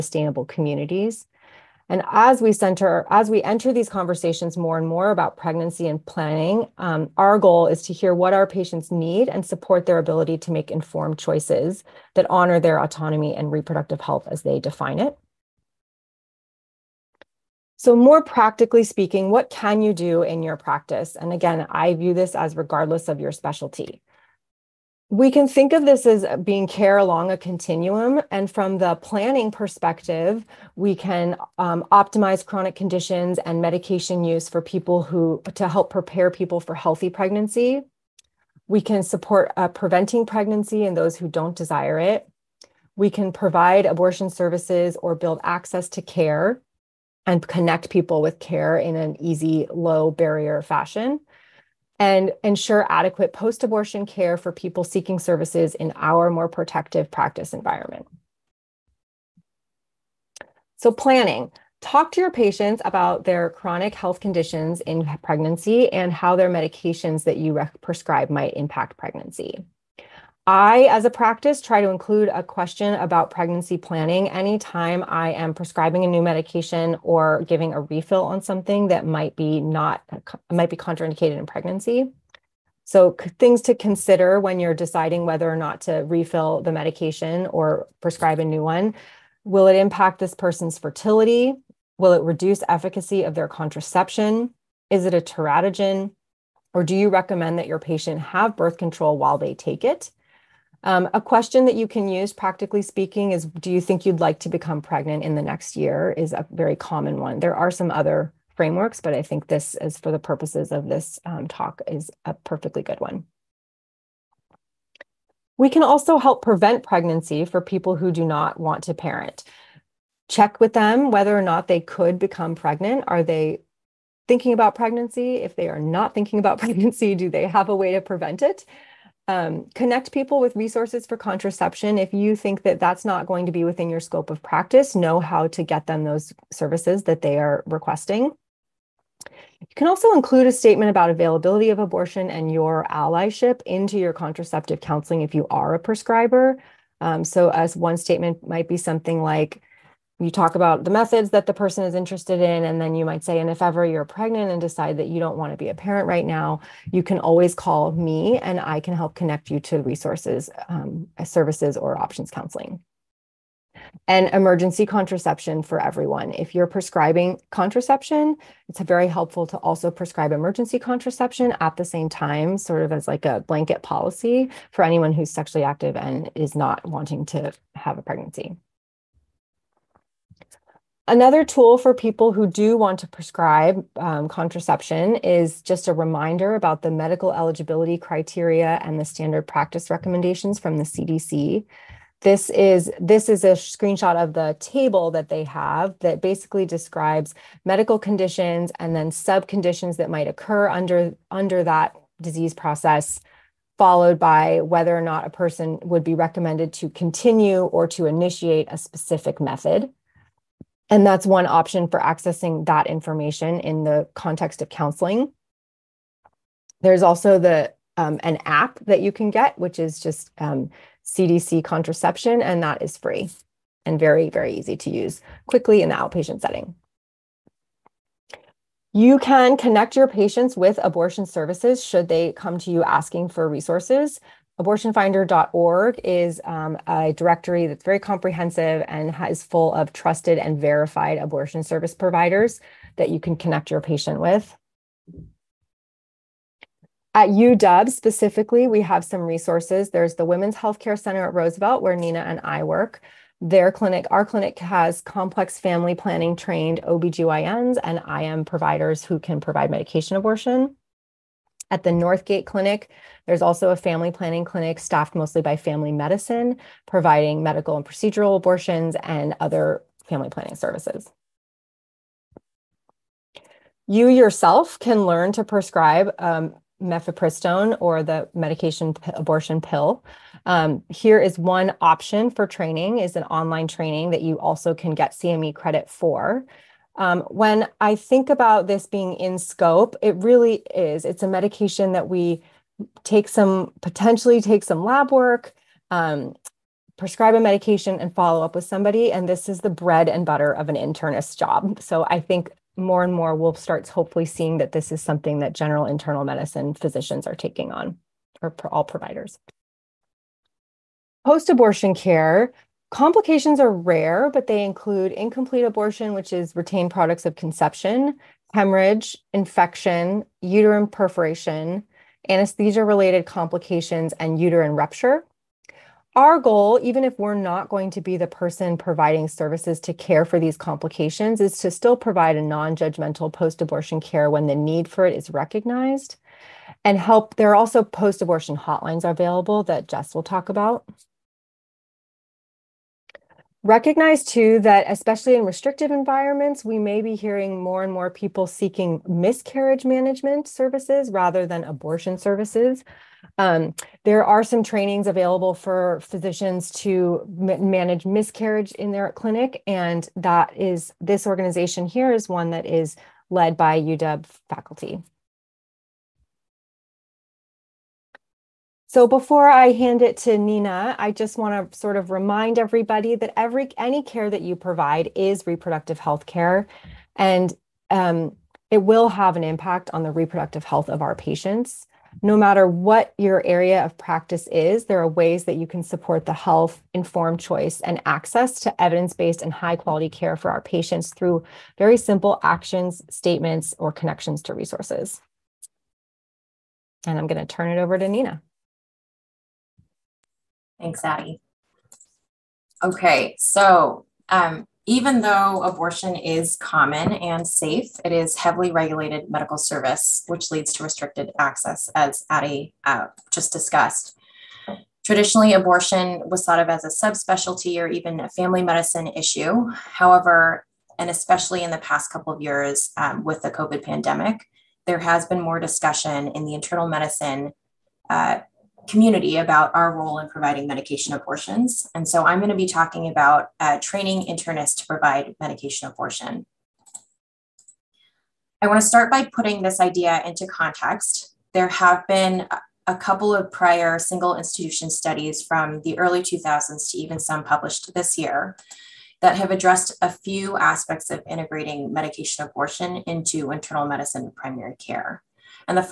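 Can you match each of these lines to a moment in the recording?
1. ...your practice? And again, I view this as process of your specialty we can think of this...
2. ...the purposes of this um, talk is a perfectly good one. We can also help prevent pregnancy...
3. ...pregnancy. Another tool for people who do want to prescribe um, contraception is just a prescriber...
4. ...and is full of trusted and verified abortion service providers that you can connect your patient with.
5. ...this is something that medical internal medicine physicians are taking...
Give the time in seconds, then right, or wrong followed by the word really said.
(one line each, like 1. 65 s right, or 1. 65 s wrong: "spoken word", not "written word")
1. 20 s wrong: "regardless", not "process"
2. 110 s right
3. 178 s wrong: "reminder", not "prescriber"
4. 238 s right
5. 304 s wrong: "general", not "medical".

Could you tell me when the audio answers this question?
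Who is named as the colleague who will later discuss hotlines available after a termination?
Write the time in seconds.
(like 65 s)
339 s.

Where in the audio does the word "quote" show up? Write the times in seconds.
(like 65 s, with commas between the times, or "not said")
not said.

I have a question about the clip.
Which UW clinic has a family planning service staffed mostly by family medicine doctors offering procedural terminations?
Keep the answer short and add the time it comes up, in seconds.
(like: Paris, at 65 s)
Northgate Clinic, at 261 s.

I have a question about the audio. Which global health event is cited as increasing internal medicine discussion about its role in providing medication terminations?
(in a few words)
the COVID pandemic.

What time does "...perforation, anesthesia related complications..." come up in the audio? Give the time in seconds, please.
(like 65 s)
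320 s.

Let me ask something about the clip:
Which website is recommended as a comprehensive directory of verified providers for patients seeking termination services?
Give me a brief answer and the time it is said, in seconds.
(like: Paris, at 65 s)
Abortionfinder.org, at 234 s.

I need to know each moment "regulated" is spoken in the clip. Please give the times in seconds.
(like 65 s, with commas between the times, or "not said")
408 s.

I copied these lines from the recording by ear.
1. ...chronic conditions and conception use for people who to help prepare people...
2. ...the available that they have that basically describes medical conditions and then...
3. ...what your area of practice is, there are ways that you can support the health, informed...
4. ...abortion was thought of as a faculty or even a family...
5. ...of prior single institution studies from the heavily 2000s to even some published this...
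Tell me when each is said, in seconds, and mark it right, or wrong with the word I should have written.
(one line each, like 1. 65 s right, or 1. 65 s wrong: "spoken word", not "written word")
1. 32 s wrong: "medication", not "conception"
2. 194 s wrong: "table", not "available"
3. 382 s right
4. 415 s wrong: "subspecialty", not "faculty"
5. 443 s wrong: "early", not "heavily".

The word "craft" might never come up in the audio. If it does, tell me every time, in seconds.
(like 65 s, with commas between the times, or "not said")
not said.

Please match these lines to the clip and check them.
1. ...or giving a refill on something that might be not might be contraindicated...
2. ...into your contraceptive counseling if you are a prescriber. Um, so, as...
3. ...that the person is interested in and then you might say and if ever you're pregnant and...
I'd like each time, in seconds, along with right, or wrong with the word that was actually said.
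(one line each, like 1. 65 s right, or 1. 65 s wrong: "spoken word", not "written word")
1. 77 s right
2. 143 s right
3. 151 s right.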